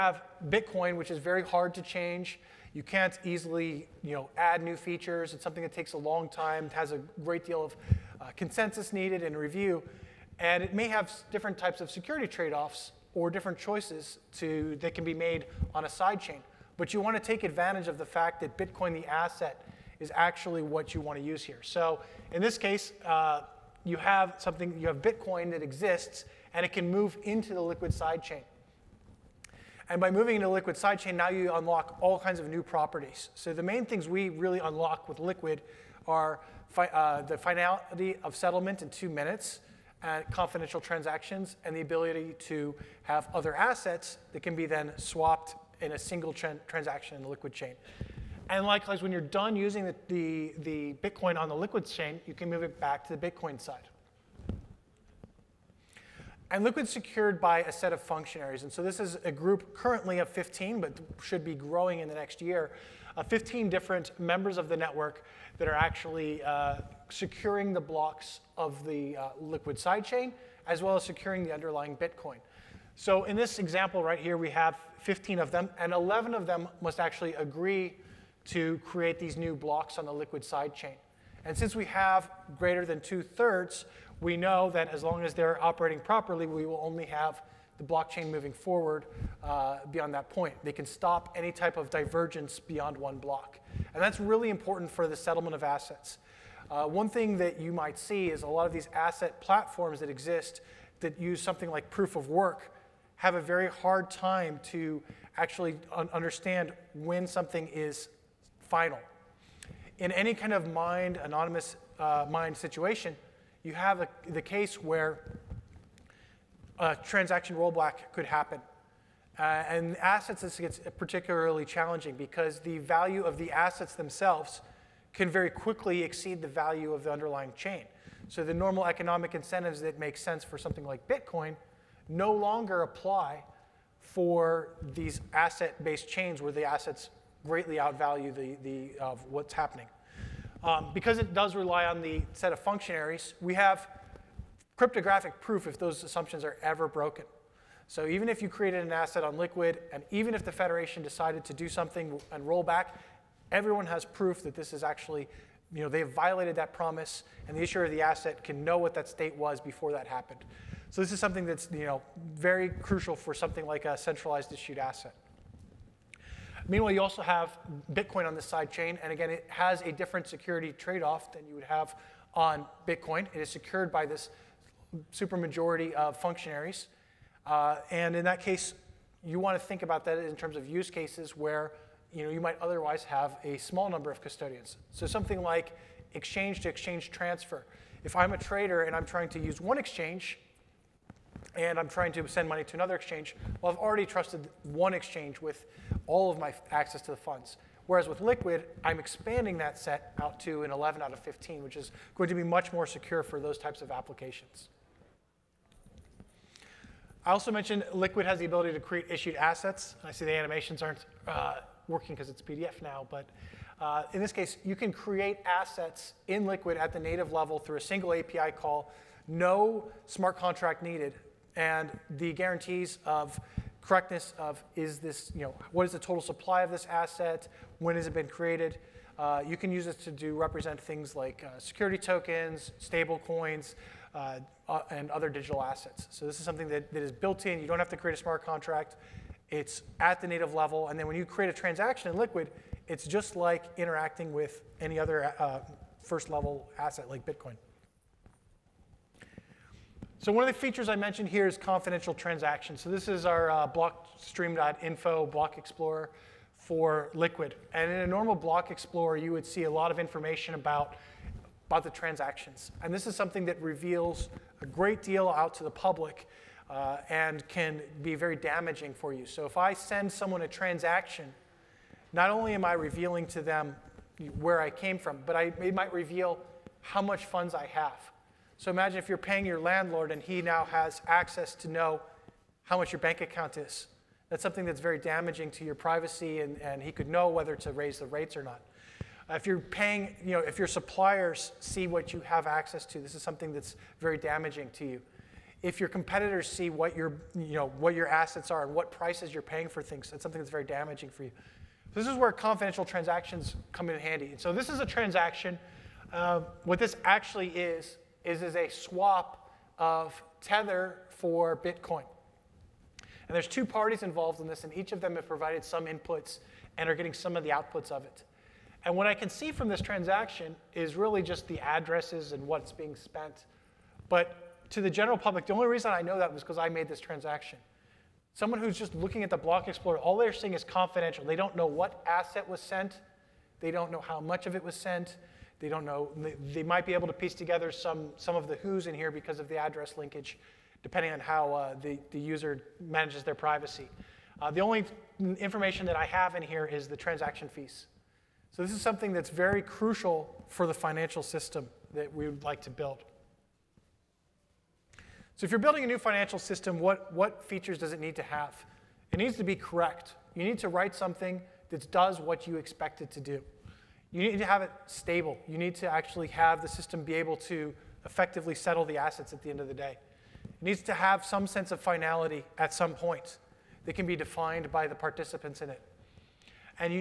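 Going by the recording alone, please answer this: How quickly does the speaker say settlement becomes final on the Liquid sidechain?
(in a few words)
2 minutes.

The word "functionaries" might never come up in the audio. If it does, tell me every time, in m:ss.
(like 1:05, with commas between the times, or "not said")
0:58, 2:22, 2:56.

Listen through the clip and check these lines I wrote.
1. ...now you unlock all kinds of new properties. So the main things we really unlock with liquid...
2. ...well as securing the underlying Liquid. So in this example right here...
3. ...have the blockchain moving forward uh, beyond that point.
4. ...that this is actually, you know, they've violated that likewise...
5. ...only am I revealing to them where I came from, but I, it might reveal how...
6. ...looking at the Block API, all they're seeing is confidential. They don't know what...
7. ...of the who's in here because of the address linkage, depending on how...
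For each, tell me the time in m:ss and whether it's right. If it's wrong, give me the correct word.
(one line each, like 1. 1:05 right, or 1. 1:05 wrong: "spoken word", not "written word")
1. 0:31 right
2. 1:10 wrong: "Bitcoin", not "Liquid"
3. 1:27 right
4. 2:34 wrong: "promise", not "likewise"
5. 4:32 right
6. 5:28 wrong: "Explorer", not "API"
7. 5:38 right.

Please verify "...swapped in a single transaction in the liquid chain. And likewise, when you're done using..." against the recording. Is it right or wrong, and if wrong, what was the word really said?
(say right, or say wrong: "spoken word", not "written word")
right.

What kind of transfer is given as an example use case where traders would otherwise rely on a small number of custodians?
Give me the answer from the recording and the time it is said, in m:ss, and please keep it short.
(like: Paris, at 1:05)
Exchange to exchange transfer, at 3:06.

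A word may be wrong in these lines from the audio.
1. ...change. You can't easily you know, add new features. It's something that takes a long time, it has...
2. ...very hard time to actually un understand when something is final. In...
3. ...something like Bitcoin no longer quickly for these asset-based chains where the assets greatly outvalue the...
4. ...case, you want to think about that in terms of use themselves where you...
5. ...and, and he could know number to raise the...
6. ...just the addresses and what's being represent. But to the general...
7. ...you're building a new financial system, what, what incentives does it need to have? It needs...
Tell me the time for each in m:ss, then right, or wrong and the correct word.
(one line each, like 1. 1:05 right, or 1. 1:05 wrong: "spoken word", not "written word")
1. 0:01 right
2. 1:43 right
3. 2:10 wrong: "apply", not "quickly"
4. 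2:58 wrong: "cases", not "themselves"
5. 4:46 wrong: "whether", not "number"
6. 5:21 wrong: "spent", not "represent"
7. 5:55 wrong: "features", not "incentives".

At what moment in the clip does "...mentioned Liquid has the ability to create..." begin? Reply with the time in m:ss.
3:27.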